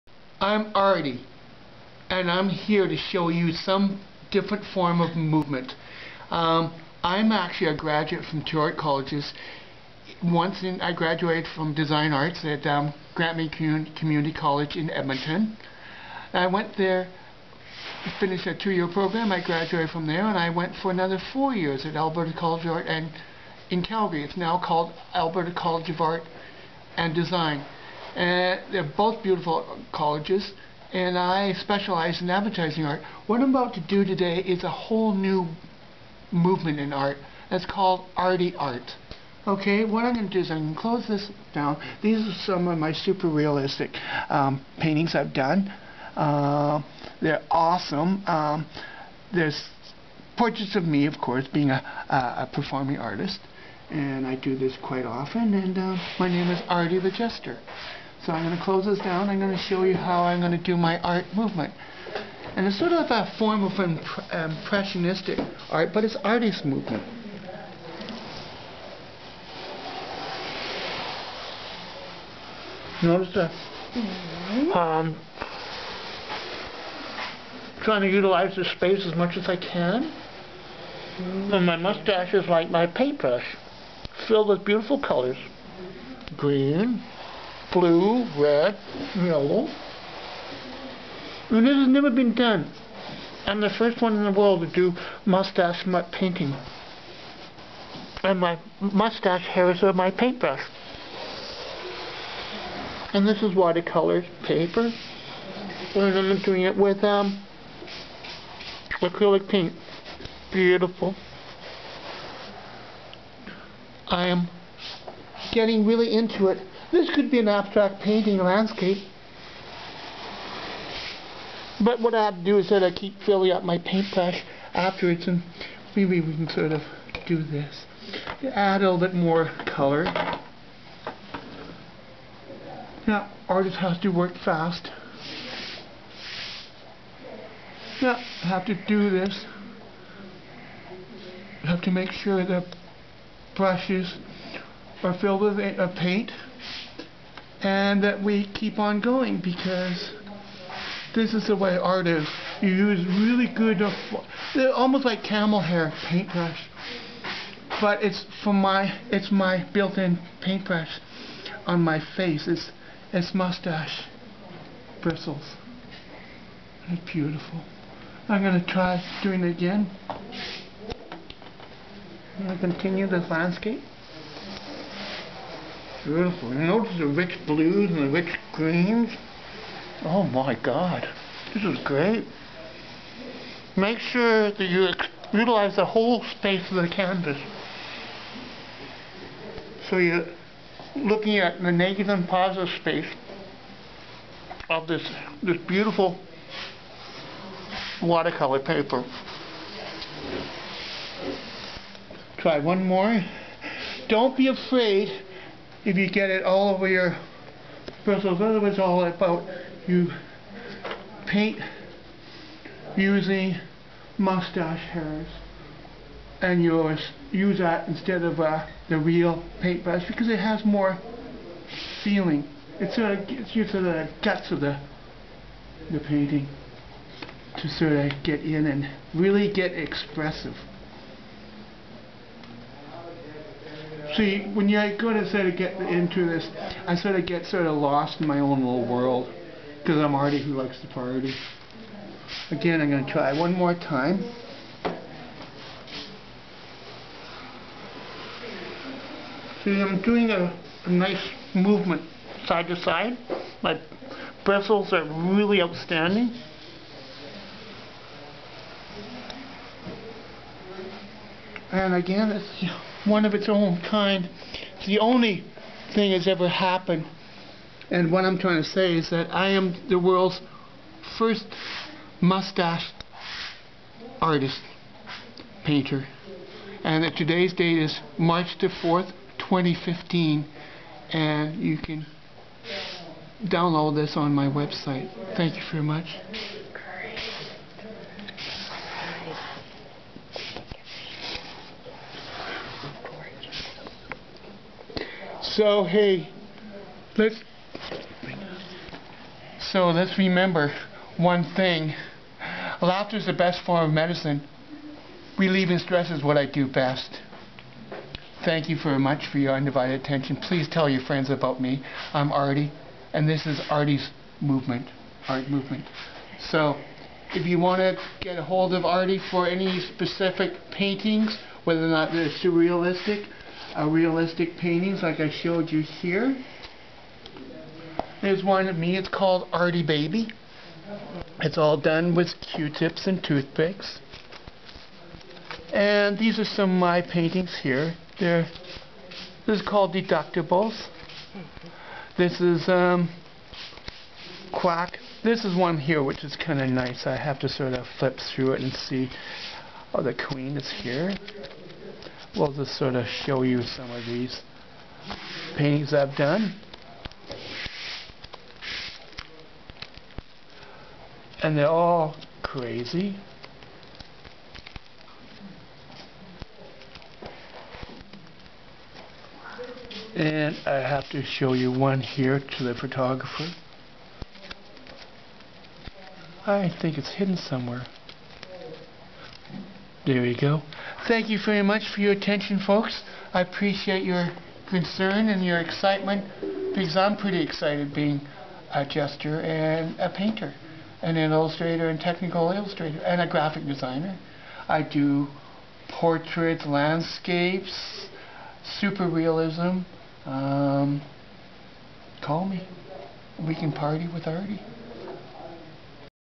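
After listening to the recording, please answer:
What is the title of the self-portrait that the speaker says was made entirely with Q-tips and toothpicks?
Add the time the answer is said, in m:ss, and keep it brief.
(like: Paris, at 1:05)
Artie Baby, at 5:29.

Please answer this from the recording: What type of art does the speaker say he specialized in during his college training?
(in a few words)
Advertising art.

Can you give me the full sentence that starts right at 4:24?
It's the only thing that's ever happened.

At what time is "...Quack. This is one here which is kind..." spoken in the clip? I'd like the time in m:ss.
5:44.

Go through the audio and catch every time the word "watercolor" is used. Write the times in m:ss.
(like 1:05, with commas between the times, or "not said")
1:43, 3:18.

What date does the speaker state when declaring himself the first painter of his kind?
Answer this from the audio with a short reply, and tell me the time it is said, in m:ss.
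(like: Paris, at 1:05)
March 4, 2015, at 4:38.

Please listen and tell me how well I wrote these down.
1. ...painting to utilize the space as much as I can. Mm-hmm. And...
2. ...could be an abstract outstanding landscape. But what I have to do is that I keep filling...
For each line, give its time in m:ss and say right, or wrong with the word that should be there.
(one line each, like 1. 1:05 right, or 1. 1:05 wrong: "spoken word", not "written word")
1. 1:17 wrong: "trying", not "painting"
2. 1:57 wrong: "painting", not "outstanding".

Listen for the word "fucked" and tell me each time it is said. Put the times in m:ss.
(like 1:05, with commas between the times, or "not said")
not said.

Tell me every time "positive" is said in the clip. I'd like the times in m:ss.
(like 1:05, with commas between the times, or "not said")
3:12.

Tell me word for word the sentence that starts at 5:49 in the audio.
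Oh, the queen is here we'll just sort of show you some of these paintings I've done.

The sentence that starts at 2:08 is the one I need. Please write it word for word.
Add a little bit more color.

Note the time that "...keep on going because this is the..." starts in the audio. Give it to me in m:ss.
2:28.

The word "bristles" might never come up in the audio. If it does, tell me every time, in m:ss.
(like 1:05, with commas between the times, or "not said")
2:45, 3:28, 4:14.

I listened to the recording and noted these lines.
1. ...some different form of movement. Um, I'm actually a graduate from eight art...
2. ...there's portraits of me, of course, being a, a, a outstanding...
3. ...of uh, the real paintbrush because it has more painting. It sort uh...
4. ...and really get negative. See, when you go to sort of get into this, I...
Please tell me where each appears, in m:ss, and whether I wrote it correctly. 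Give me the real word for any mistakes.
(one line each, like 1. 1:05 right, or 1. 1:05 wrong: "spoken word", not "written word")
1. 0:03 wrong: "two", not "eight"
2. 0:49 wrong: "performing", not "outstanding"
3. 3:38 wrong: "feeling", not "painting"
4. 3:48 wrong: "expressive", not "negative".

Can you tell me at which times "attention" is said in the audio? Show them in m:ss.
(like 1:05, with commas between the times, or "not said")
5:09, 6:22.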